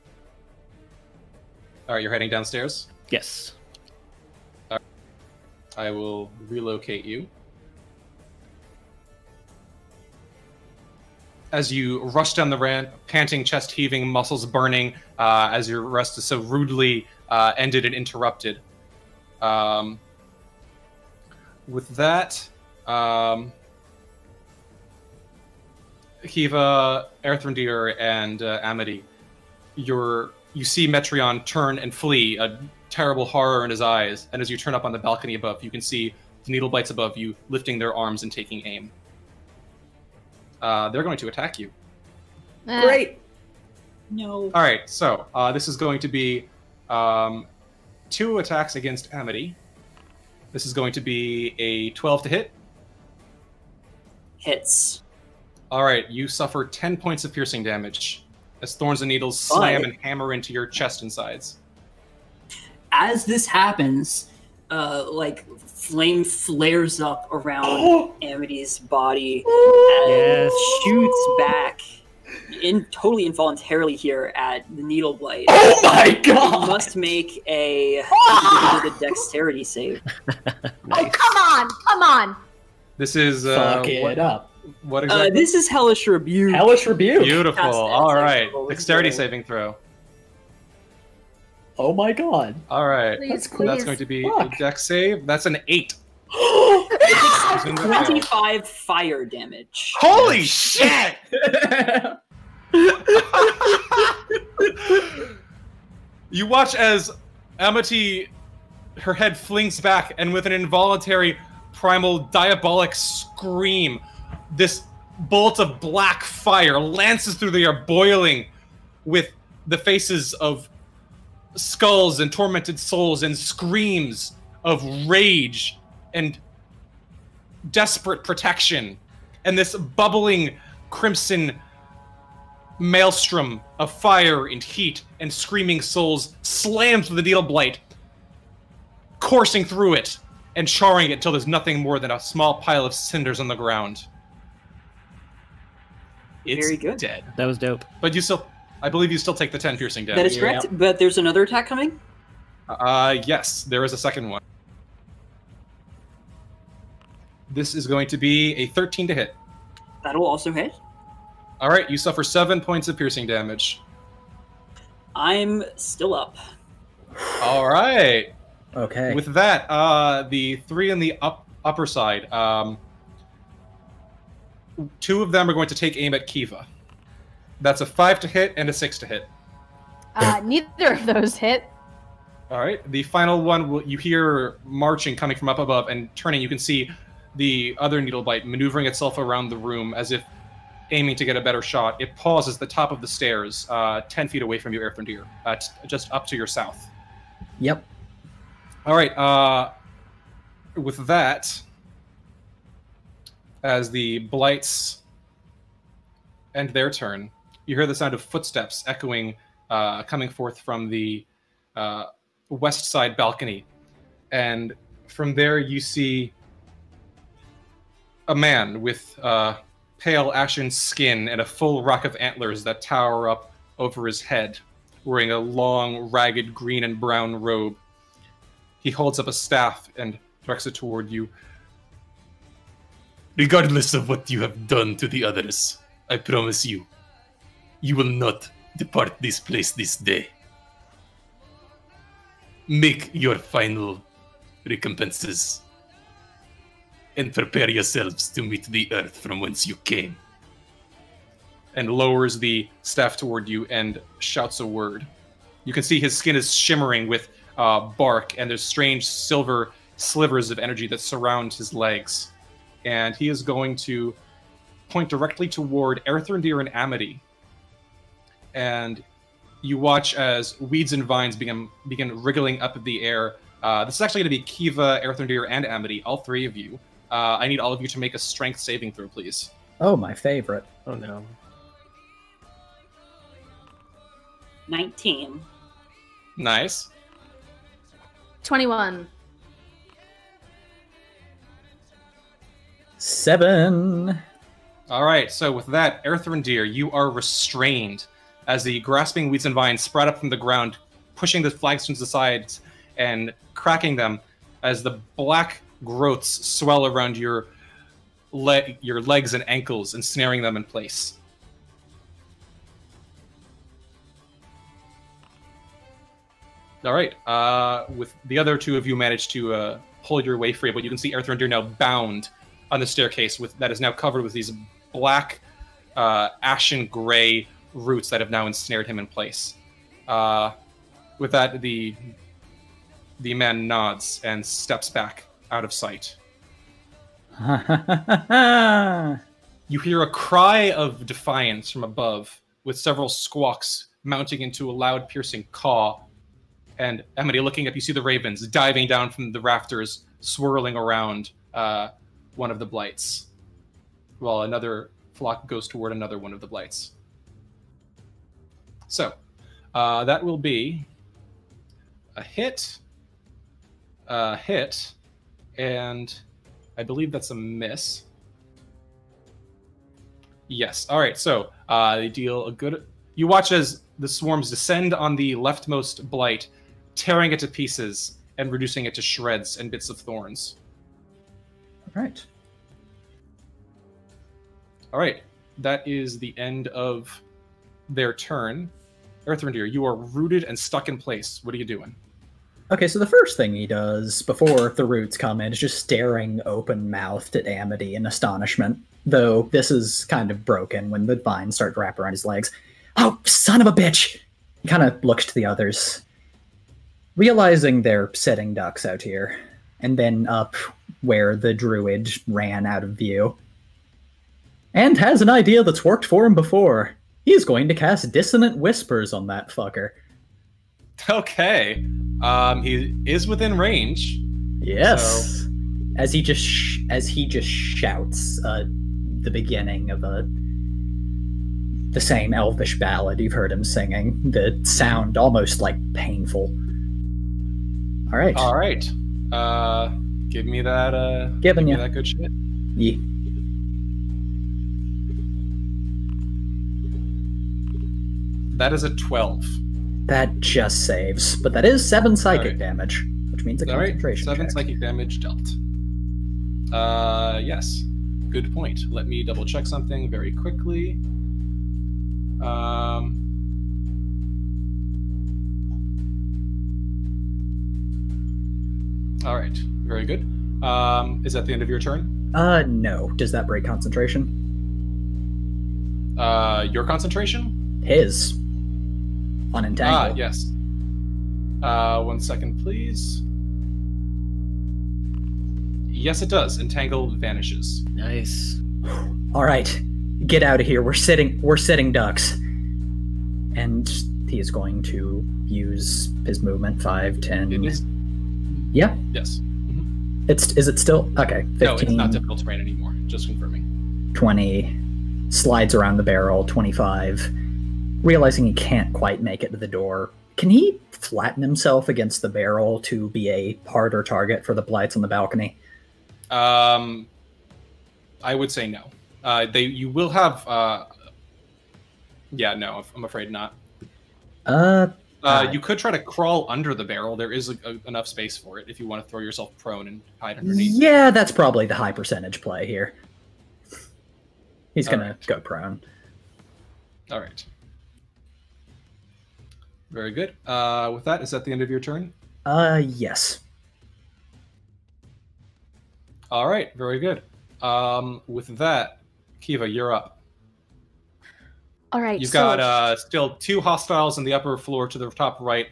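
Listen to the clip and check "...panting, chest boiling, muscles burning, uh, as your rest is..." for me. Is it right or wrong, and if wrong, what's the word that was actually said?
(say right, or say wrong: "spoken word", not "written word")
wrong: "heaving", not "boiling".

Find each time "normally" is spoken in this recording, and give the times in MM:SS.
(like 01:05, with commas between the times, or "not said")
not said.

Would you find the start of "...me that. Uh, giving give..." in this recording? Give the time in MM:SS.
07:20.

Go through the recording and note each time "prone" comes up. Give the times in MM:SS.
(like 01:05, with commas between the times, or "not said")
08:49, 08:55.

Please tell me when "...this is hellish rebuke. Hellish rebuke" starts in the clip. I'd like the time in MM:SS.
01:25.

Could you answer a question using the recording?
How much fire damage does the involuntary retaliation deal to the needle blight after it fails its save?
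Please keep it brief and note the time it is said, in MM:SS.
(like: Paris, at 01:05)
25, at 01:37.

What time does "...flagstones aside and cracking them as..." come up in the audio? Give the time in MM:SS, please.
05:01.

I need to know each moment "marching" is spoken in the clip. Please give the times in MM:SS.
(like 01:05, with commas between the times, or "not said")
03:04.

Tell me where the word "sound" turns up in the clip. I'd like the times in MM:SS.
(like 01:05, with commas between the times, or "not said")
03:27, 07:14.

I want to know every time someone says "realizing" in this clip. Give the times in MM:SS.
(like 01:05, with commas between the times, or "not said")
06:47, 08:28.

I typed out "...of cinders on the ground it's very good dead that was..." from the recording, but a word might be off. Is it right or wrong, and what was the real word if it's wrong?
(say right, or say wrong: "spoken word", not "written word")
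right.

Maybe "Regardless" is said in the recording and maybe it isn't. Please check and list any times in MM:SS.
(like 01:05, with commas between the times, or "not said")
03:53.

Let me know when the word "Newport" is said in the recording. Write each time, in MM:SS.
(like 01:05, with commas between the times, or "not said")
not said.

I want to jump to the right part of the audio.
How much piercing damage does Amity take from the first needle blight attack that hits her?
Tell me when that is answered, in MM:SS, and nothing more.
00:56.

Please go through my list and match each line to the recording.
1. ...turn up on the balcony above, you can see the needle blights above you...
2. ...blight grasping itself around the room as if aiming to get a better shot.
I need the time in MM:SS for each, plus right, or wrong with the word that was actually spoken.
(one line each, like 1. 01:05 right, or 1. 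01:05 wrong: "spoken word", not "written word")
1. 00:34 right
2. 03:08 wrong: "maneuvering", not "grasping".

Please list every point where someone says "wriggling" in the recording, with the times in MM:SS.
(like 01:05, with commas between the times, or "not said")
04:32.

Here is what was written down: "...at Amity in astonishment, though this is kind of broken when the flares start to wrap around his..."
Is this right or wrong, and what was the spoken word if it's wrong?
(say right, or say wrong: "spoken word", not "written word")
wrong: "vines", not "flares".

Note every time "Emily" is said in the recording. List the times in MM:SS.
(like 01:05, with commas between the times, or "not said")
05:47.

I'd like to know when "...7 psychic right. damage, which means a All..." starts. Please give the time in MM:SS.
07:31.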